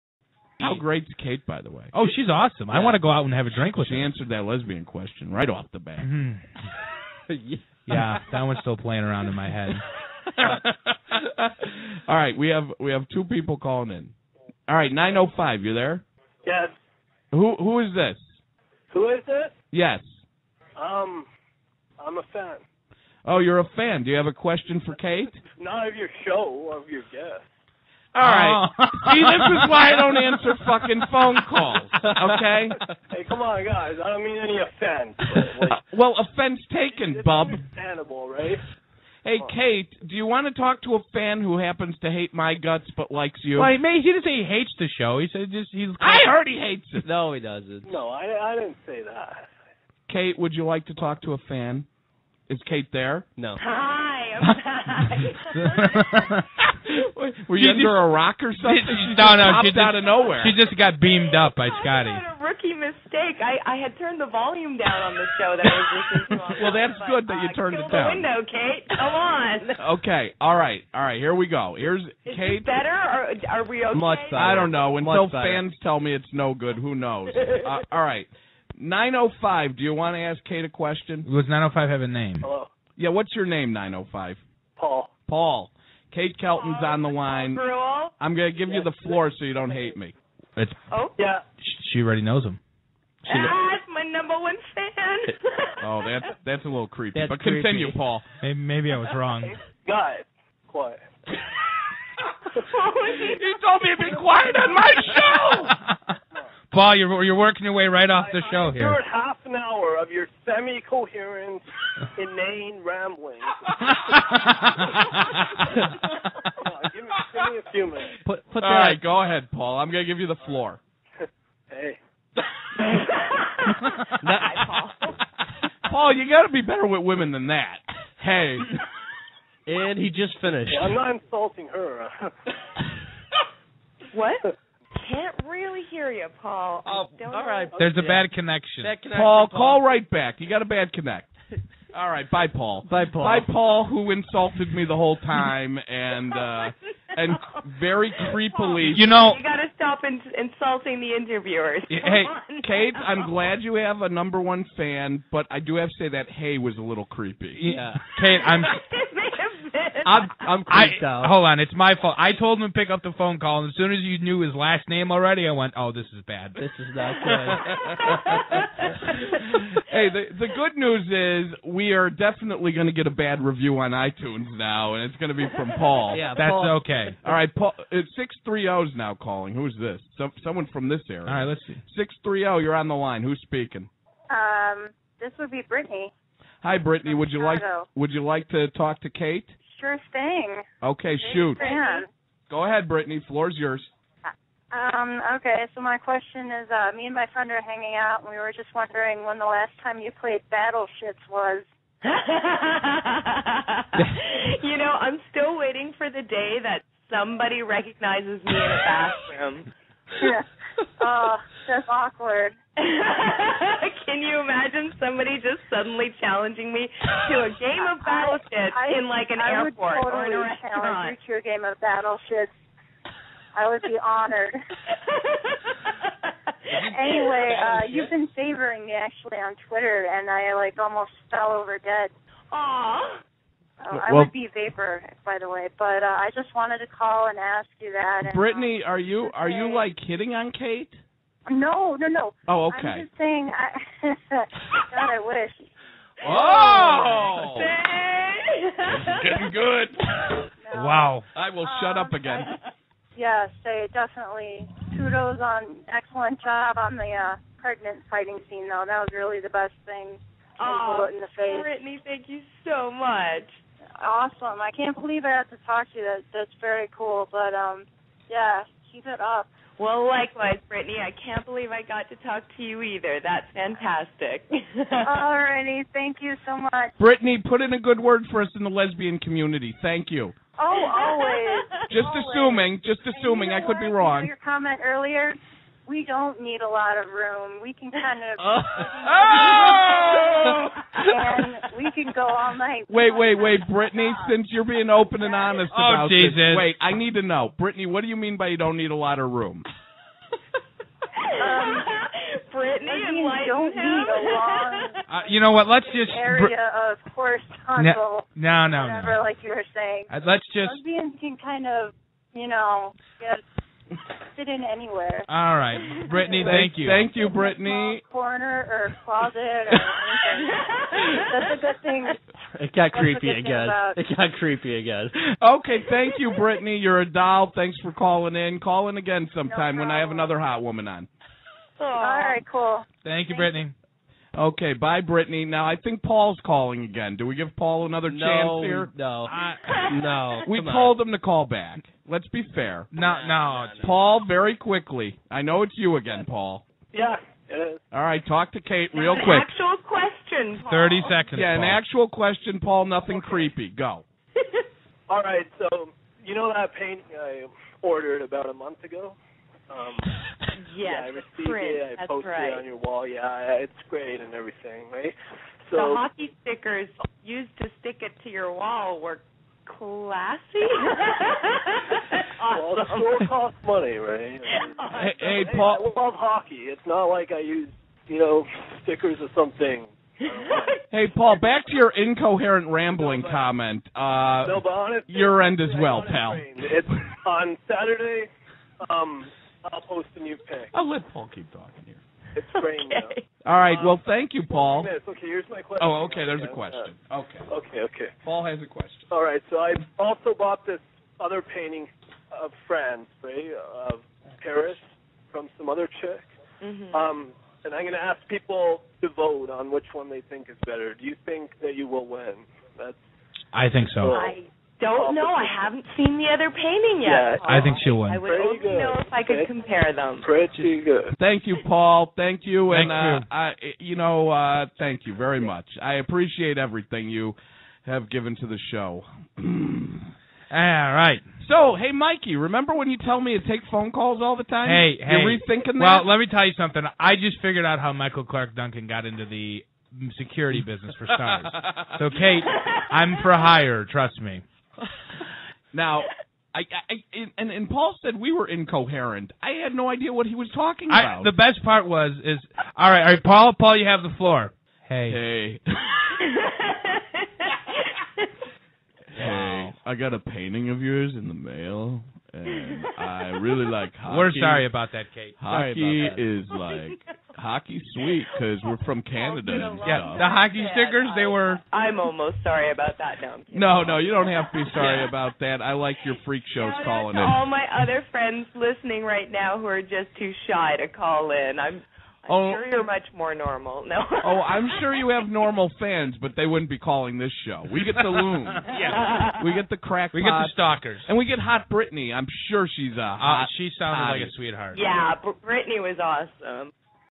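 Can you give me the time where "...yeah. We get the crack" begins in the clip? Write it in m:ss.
8:08.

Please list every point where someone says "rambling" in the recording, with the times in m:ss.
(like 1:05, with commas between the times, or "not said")
1:52, 6:22.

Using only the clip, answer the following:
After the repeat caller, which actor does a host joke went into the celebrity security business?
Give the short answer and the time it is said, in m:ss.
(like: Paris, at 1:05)
Michael Clark Duncan, at 7:17.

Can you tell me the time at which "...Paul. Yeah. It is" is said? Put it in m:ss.
5:46.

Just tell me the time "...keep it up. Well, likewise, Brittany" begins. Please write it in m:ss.
4:28.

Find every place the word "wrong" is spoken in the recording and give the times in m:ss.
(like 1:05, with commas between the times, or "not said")
1:39, 4:43.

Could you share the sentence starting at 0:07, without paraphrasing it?
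Yeah, that one's still playing around in my head.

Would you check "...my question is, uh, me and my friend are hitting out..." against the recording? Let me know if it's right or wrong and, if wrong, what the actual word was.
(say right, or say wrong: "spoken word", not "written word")
wrong: "hanging", not "hitting".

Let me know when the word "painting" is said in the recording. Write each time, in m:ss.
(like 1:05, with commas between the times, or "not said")
5:56, 6:41, 6:56, 7:40.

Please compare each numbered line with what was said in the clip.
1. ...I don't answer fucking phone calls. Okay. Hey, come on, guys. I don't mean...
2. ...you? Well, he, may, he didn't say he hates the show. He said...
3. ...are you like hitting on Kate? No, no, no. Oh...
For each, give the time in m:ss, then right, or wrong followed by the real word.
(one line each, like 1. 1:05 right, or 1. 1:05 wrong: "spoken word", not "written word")
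1. 0:29 right
2. 0:43 right
3. 3:59 right.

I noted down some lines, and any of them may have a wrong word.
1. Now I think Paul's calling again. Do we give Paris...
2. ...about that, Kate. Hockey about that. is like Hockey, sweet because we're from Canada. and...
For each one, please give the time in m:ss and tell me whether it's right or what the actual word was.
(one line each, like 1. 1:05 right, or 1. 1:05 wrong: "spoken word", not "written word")
1. 5:35 wrong: "Paul", not "Paris"
2. 7:44 right.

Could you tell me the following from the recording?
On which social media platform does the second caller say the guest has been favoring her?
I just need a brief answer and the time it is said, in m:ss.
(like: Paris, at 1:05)
Twitter, at 3:49.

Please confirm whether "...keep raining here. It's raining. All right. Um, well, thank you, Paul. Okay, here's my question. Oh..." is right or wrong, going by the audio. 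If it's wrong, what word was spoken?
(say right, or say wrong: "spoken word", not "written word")
wrong: "talking", not "raining".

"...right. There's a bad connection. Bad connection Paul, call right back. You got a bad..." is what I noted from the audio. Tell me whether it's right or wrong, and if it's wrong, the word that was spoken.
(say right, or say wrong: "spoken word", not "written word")
right.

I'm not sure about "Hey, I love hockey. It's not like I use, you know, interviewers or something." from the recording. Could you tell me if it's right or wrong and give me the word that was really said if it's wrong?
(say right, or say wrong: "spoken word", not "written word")
wrong: "stickers", not "interviewers".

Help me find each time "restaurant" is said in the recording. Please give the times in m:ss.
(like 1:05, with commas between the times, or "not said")
3:40.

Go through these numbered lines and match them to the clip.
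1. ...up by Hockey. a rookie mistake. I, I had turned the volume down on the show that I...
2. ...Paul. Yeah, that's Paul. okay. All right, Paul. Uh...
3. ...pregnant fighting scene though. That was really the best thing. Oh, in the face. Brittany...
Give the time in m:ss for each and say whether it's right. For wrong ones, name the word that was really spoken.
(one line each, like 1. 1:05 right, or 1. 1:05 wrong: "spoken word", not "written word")
1. 1:01 wrong: "Scotty", not "Hockey"
2. 2:55 right
3. 4:17 right.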